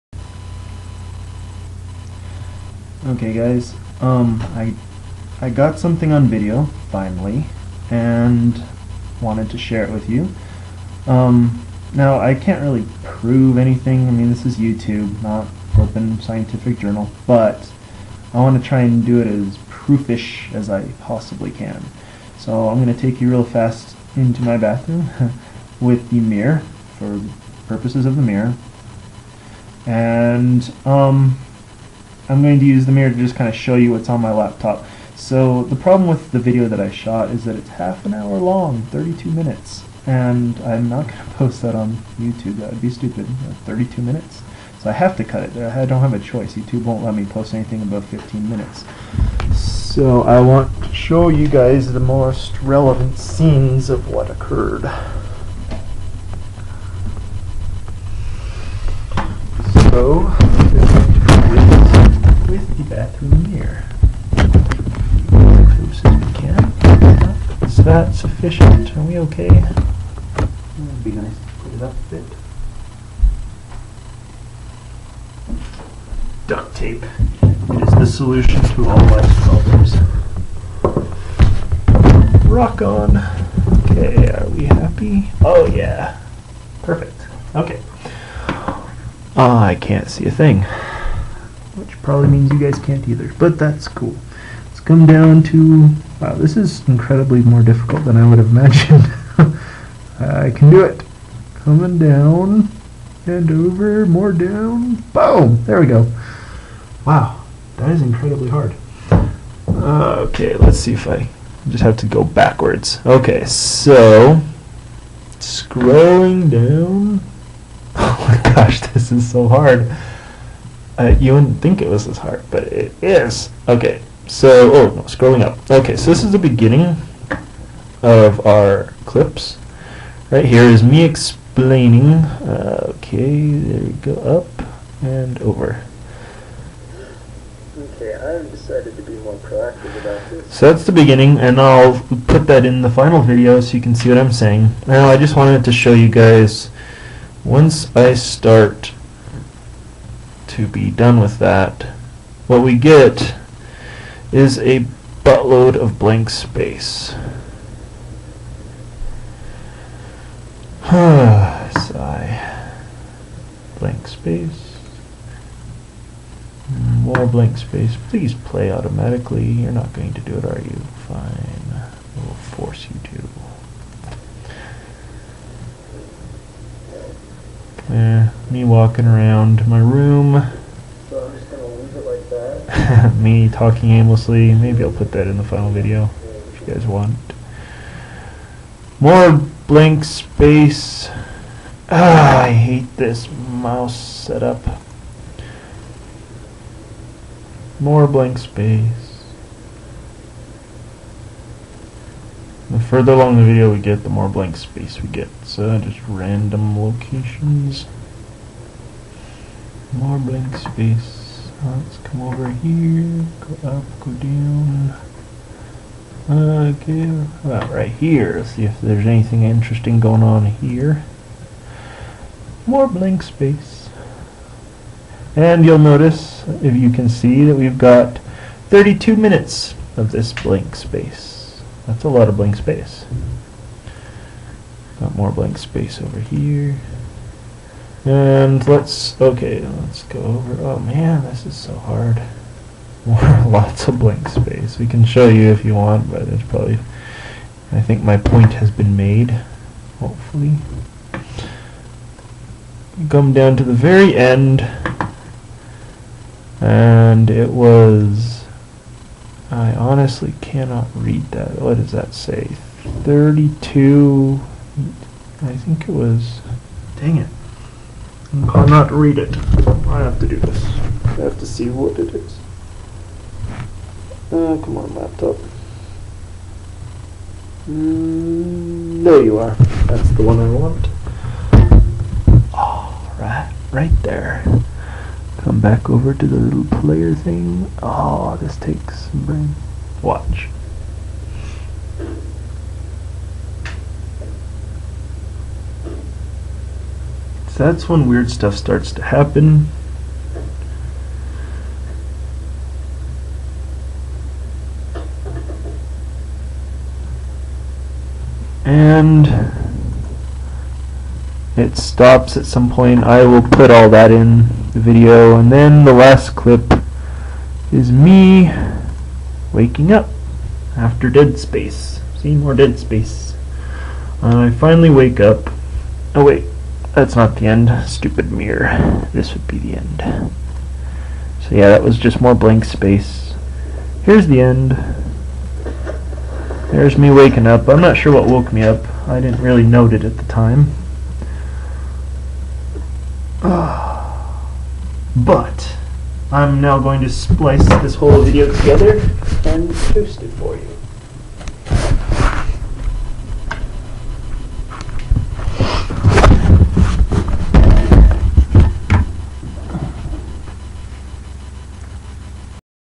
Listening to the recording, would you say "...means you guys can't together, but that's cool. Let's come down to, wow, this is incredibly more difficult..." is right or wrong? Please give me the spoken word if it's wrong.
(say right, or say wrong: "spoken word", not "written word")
wrong: "either", not "together".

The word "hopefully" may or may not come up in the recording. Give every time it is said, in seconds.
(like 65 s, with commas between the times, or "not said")
249 s.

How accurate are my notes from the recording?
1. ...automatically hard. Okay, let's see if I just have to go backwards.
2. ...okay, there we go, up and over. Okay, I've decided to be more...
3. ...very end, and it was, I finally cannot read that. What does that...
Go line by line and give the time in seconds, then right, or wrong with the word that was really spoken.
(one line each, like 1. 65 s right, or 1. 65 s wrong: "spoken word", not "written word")
1. 108 s wrong: "incredibly", not "automatically"
2. 132 s right
3. 253 s wrong: "honestly", not "finally".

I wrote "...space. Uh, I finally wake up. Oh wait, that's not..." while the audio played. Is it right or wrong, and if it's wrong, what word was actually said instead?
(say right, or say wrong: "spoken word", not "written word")
right.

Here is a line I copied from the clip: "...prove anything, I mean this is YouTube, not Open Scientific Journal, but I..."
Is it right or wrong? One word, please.
right.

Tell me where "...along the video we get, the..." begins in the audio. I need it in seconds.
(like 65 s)
203 s.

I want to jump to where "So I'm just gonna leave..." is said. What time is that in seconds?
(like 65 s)
181 s.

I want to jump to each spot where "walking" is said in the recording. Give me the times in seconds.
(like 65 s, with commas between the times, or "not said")
178 s.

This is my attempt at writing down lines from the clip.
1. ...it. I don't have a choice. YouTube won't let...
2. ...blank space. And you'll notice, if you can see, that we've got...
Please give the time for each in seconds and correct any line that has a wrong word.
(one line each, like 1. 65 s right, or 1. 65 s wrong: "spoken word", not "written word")
1. 45 s right
2. 222 s right.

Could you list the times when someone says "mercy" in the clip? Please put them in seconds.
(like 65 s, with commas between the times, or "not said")
not said.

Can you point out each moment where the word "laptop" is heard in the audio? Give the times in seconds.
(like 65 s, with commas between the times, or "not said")
34 s, 274 s.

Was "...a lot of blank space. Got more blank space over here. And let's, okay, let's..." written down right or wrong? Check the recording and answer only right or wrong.
right.